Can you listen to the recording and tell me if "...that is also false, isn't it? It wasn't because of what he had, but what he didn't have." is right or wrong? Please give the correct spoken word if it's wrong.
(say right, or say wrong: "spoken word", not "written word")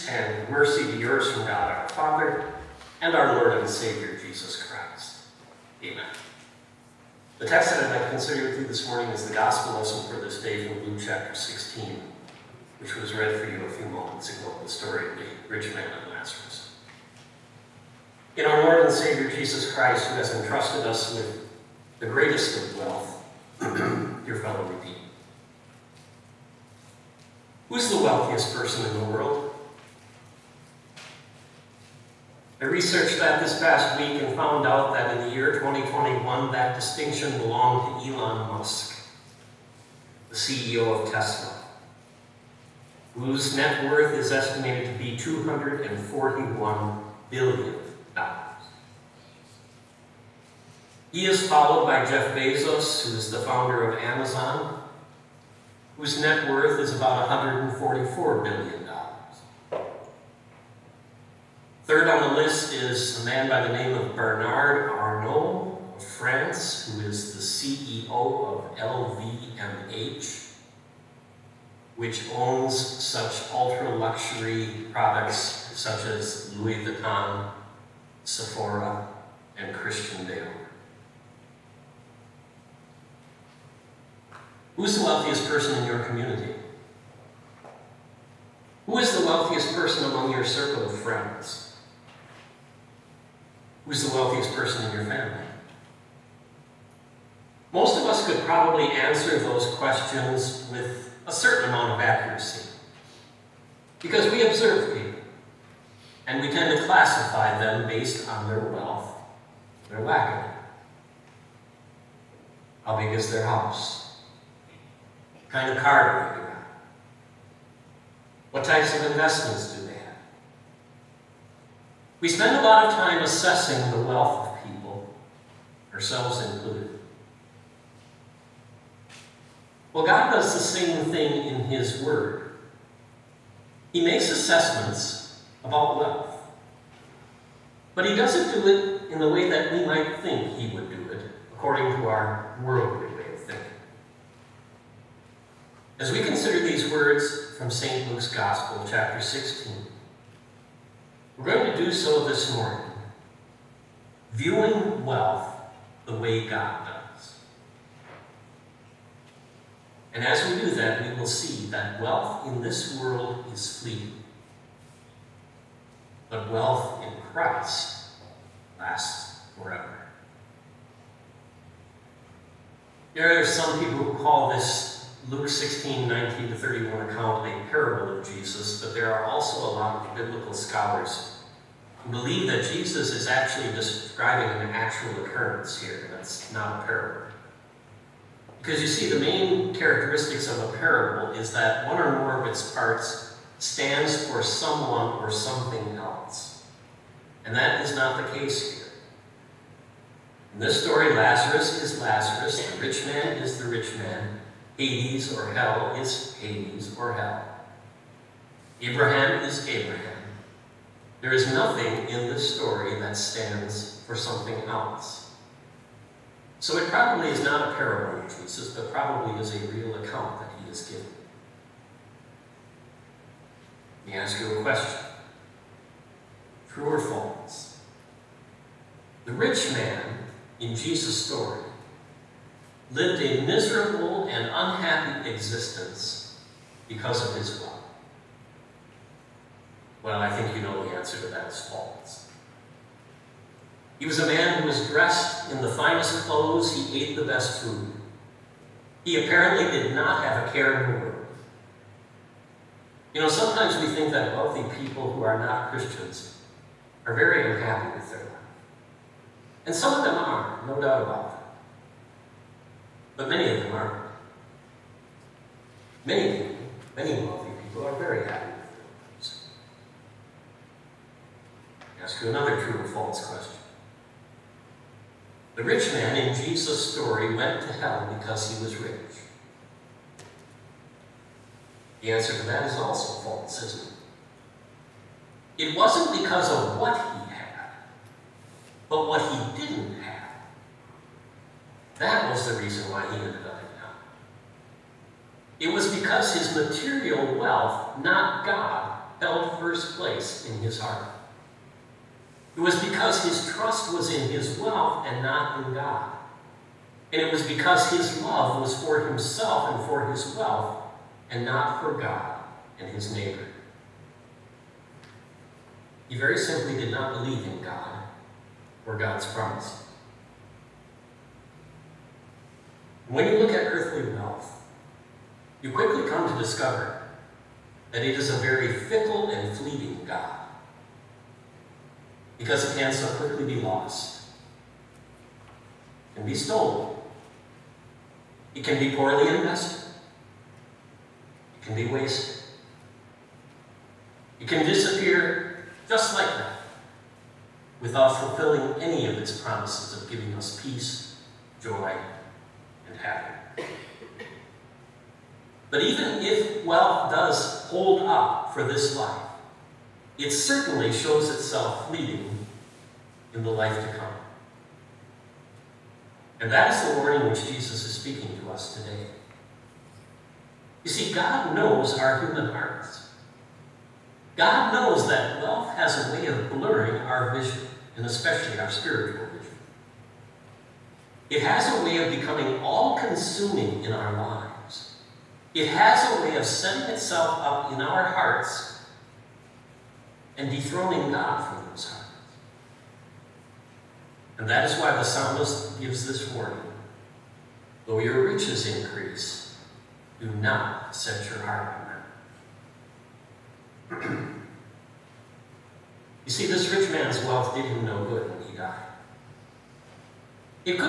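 right.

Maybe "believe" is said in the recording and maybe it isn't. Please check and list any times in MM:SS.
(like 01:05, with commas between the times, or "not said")
03:02, 05:17.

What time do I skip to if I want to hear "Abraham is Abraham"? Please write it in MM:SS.
03:28.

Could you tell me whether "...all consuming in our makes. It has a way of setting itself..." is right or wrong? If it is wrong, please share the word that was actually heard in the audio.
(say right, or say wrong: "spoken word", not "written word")
wrong: "lives", not "makes".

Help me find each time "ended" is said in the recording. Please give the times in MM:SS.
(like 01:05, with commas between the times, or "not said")
04:53.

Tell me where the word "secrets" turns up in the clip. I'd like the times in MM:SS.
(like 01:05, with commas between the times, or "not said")
not said.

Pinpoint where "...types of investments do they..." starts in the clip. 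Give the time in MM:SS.
01:58.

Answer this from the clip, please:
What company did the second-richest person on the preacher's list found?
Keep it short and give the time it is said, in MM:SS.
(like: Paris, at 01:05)
Amazon, at 00:54.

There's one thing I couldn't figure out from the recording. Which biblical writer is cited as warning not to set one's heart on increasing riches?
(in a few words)
the psalmist.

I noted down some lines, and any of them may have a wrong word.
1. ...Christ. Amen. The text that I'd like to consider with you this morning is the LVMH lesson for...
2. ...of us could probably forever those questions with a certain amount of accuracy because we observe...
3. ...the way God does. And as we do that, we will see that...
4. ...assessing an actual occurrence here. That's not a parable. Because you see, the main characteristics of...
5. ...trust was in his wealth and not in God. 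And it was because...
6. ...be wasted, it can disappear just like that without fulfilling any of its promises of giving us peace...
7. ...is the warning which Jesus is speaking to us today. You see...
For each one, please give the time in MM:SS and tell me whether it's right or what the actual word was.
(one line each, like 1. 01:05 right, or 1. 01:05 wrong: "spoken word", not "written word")
1. 00:04 wrong: "Gospel", not "LVMH"
2. 01:37 wrong: "answer", not "forever"
3. 02:36 right
4. 03:03 wrong: "describing", not "assessing"
5. 05:03 right
6. 05:41 right
7. 06:06 right.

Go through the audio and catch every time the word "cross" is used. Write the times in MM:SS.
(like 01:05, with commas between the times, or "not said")
not said.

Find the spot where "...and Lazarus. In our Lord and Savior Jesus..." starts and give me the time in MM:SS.
00:16.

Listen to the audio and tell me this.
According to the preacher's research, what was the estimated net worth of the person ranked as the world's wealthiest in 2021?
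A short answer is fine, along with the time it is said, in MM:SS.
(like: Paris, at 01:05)
$241 billion, at 00:45.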